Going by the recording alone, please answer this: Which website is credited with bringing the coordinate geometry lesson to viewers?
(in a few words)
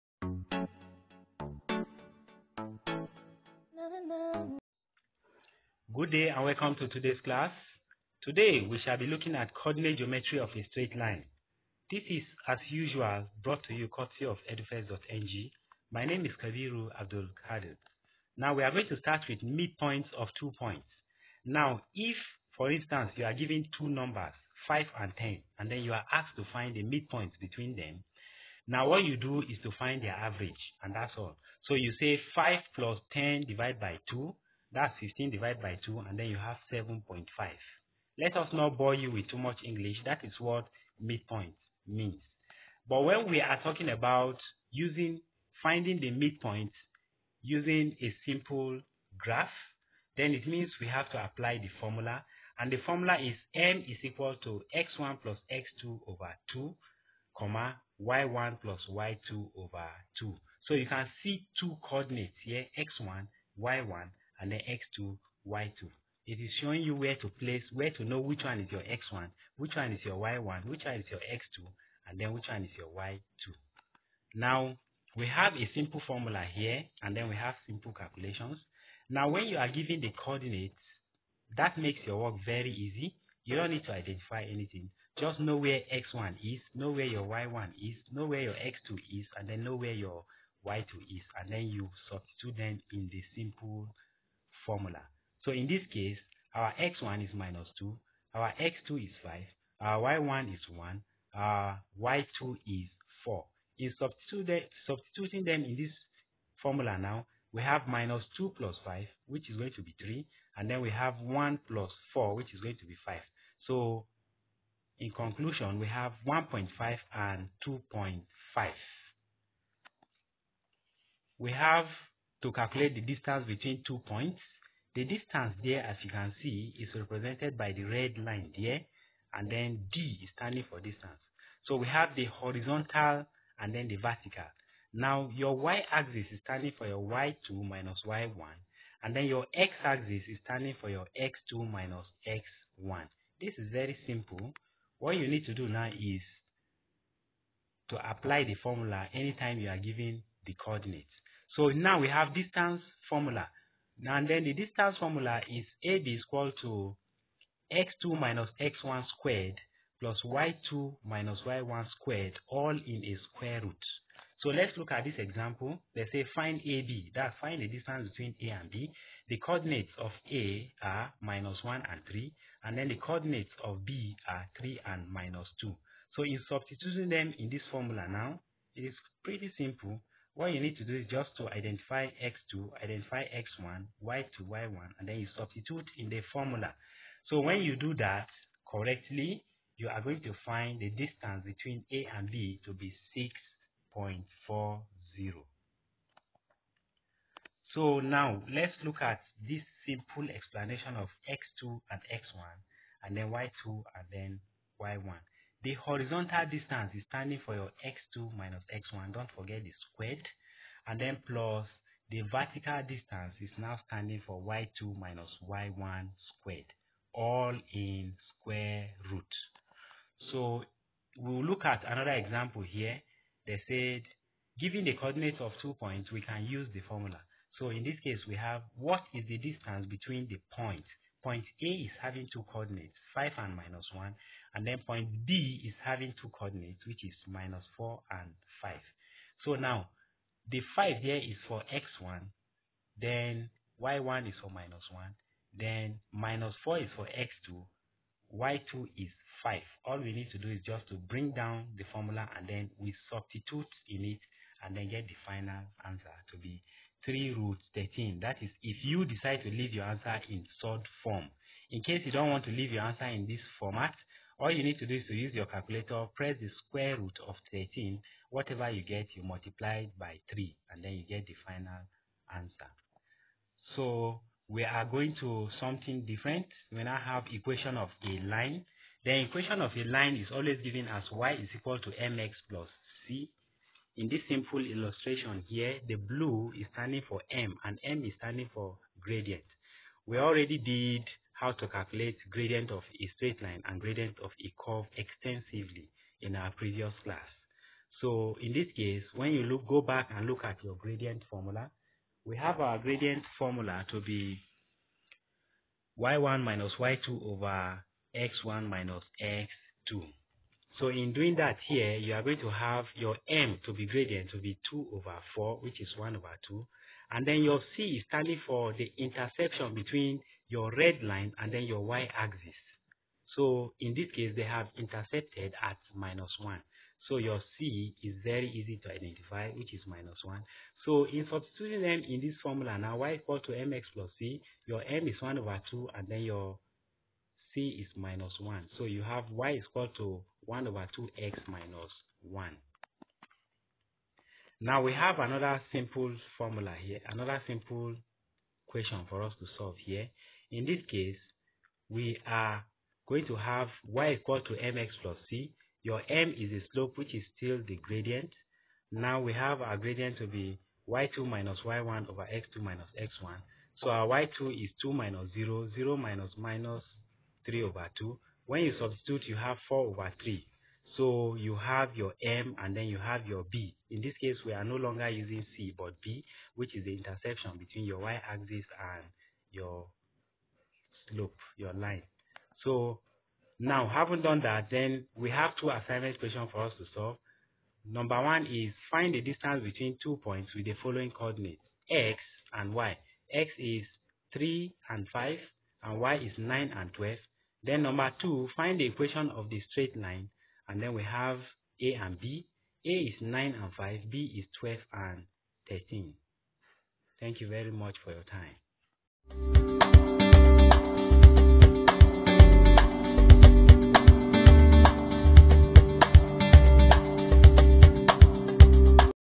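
edufirst.ng.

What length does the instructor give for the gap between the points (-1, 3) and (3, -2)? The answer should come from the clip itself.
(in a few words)
6.40.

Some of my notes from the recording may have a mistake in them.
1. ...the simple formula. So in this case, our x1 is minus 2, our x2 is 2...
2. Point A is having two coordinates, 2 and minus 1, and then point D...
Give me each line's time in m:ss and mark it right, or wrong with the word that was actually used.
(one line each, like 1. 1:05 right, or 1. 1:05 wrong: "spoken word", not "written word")
1. 1:33 wrong: "5", not "2"
2. 3:51 wrong: "5", not "2".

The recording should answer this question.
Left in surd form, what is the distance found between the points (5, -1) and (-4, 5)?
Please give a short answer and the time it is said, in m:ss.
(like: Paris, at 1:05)
3 root 13, at 4:17.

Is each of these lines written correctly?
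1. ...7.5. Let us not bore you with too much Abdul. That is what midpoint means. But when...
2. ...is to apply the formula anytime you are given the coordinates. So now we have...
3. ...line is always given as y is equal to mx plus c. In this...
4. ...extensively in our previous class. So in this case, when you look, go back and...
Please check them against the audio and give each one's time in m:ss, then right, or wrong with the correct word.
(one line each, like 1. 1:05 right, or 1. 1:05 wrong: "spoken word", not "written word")
1. 0:36 wrong: "English", not "Abdul"
2. 2:25 right
3. 4:39 right
4. 4:54 right.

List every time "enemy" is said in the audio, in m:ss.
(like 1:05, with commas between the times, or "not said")
not said.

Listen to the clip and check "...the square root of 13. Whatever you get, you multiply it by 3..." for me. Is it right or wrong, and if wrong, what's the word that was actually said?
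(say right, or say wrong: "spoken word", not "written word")
right.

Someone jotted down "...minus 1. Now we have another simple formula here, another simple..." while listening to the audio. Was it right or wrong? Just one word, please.
right.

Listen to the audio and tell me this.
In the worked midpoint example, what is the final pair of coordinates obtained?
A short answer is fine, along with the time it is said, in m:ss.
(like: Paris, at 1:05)
1.5 and 2.5, at 1:56.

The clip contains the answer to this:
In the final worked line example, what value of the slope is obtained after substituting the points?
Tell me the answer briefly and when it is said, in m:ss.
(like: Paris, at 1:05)
4/3, at 6:09.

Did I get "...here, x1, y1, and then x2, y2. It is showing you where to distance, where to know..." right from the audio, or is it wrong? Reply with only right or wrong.
wrong.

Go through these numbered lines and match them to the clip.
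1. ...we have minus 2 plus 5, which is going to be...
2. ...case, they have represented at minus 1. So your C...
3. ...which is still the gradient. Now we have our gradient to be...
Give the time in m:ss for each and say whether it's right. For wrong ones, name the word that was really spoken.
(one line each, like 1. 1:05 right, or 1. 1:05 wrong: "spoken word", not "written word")
1. 1:47 right
2. 5:24 wrong: "intersected", not "represented"
3. 5:56 right.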